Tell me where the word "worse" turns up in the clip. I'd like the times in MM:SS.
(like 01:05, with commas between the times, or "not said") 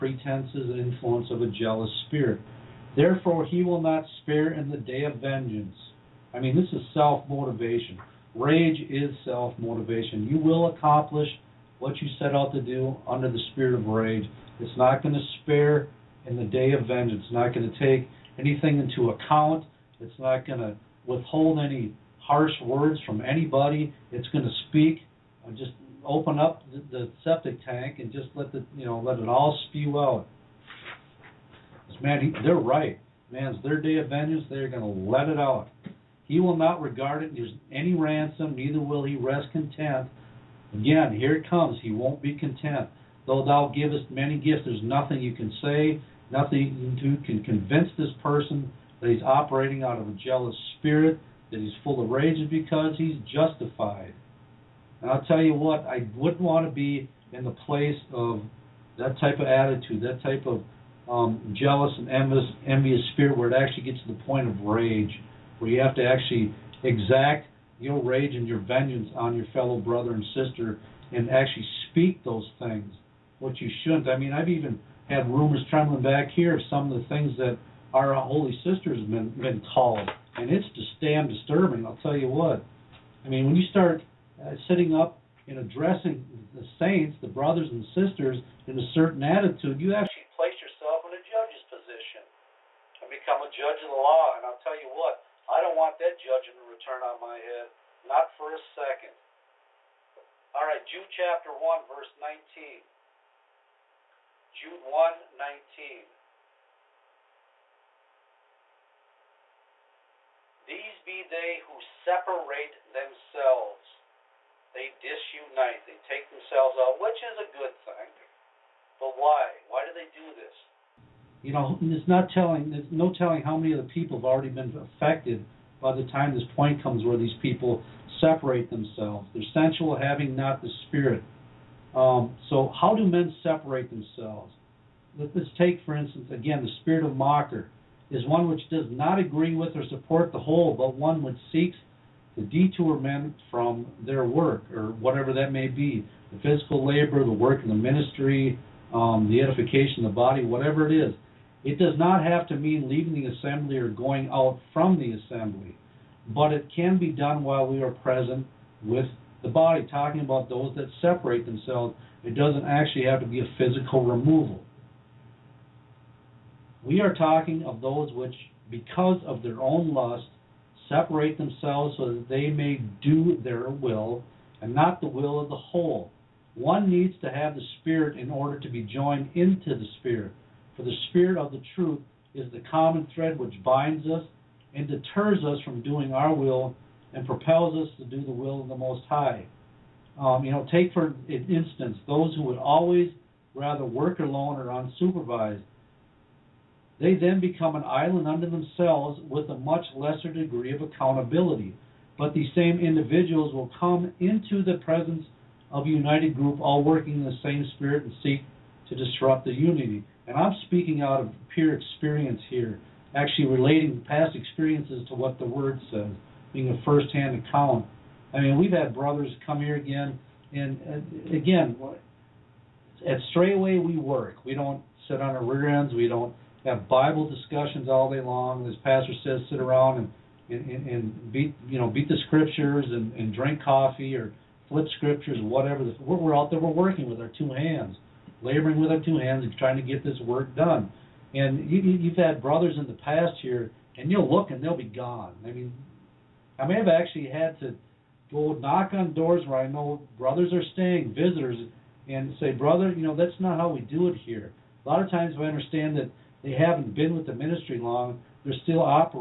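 not said.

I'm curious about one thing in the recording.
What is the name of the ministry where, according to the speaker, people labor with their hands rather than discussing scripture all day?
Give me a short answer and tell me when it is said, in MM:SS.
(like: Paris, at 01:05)
Straitway, at 03:43.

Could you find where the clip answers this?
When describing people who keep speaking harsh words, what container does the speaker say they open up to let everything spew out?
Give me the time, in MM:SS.
00:27.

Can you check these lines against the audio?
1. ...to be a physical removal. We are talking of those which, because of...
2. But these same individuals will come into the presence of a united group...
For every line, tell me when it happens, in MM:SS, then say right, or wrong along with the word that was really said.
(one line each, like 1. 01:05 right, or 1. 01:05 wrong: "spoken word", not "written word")
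1. 02:43 right
2. 03:22 right.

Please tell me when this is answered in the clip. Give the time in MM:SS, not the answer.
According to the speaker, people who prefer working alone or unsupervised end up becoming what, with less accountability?
03:17.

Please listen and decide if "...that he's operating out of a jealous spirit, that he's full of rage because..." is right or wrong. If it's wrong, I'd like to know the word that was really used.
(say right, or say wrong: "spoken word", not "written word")
right.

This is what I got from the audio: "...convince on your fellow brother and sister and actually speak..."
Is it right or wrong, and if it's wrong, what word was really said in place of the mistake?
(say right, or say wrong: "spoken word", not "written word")
wrong: "vengeance", not "convince".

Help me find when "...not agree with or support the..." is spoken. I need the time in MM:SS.
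02:18.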